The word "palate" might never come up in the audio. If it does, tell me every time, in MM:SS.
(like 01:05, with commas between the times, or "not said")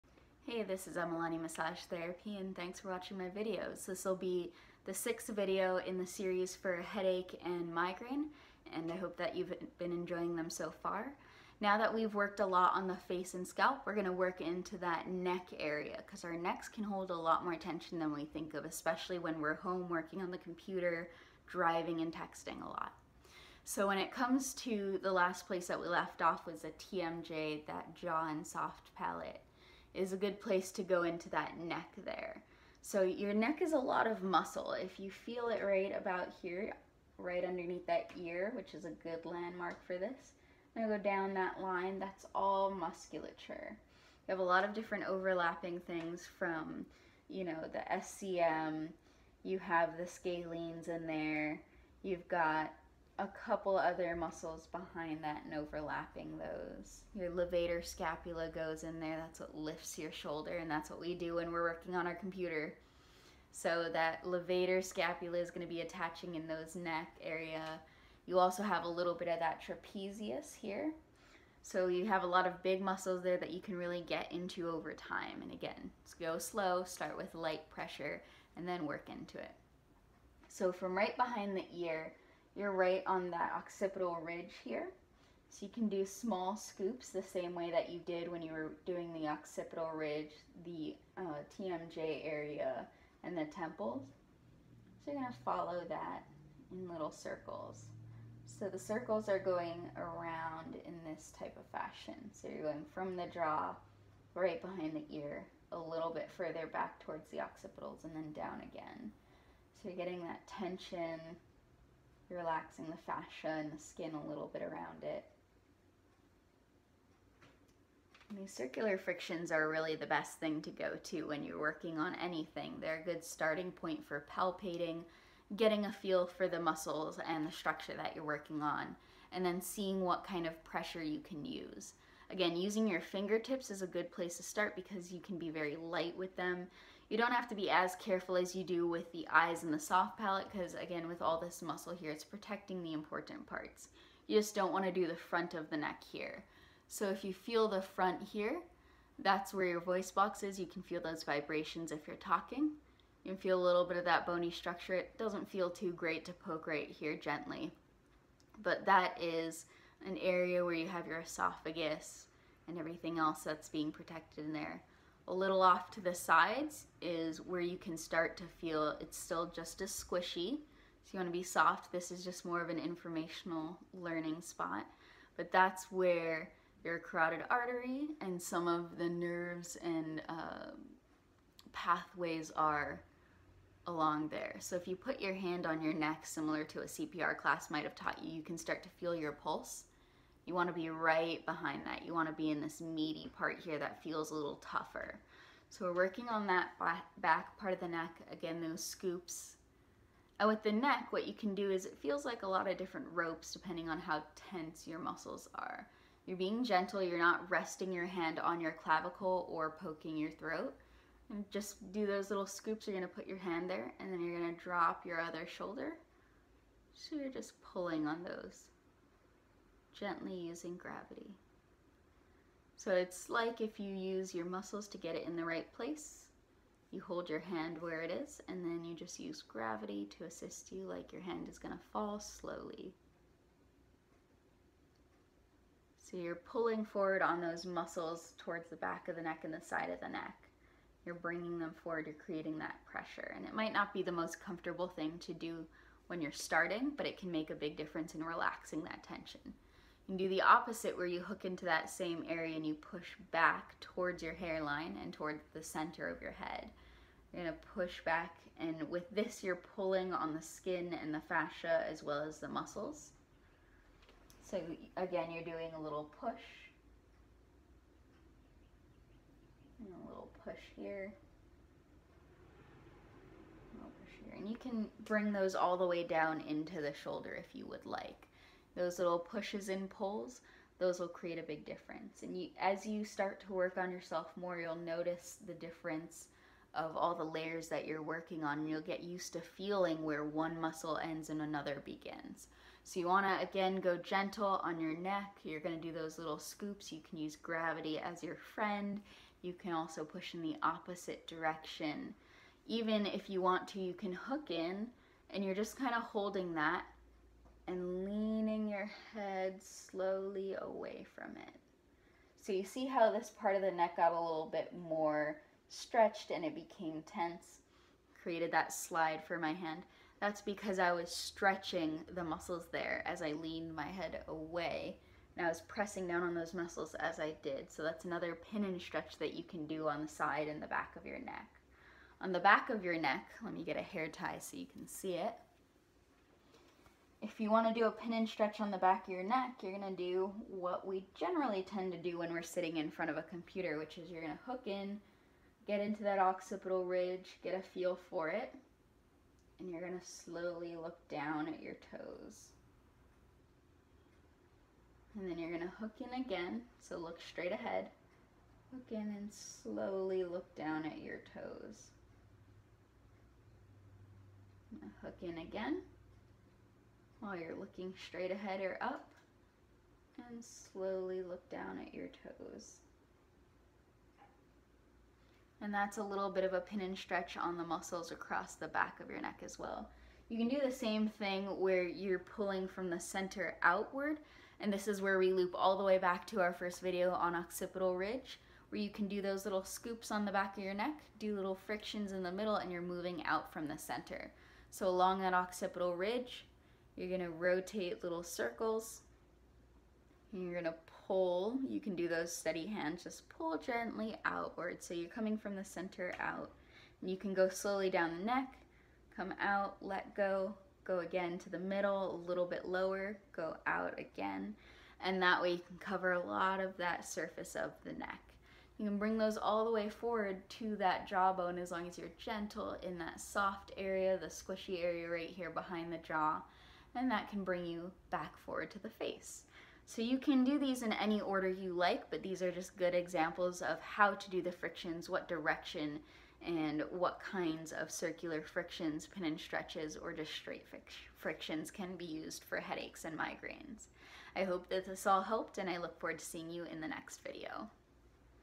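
00:28, 02:20.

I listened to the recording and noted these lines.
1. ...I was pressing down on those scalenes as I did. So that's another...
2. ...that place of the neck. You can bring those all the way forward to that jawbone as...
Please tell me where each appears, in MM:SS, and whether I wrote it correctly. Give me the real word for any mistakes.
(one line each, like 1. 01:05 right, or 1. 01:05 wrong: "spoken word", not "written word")
1. 05:25 wrong: "muscles", not "scalenes"
2. 06:56 wrong: "surface", not "place".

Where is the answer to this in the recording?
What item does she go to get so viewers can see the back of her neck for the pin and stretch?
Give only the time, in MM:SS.
05:33.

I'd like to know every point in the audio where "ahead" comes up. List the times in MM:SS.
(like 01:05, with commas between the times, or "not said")
05:57, 06:08.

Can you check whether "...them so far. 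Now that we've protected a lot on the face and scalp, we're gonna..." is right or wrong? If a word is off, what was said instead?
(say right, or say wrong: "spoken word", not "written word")
wrong: "worked", not "protected".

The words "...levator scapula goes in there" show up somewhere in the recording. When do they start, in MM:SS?
00:57.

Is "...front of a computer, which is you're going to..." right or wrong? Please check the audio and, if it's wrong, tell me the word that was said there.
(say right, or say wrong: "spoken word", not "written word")
right.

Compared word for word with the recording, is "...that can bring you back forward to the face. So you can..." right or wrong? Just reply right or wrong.
right.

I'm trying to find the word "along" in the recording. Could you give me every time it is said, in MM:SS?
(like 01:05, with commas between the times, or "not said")
03:03, 06:34.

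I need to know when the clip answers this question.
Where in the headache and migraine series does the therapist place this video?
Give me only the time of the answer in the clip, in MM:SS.
00:04.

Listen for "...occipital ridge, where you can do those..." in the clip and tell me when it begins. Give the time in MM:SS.
06:27.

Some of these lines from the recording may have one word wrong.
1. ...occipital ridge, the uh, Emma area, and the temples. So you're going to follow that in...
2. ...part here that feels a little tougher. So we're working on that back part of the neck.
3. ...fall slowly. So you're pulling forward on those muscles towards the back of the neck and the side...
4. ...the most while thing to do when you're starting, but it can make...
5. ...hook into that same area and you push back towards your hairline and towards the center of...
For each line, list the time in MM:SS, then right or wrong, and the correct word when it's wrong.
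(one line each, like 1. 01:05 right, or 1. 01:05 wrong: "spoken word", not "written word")
1. 01:29 wrong: "TMJ", not "Emma"
2. 03:13 right
3. 03:51 right
4. 04:04 wrong: "comfortable", not "while"
5. 04:11 right.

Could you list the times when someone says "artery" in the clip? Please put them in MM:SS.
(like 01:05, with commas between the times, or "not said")
02:57.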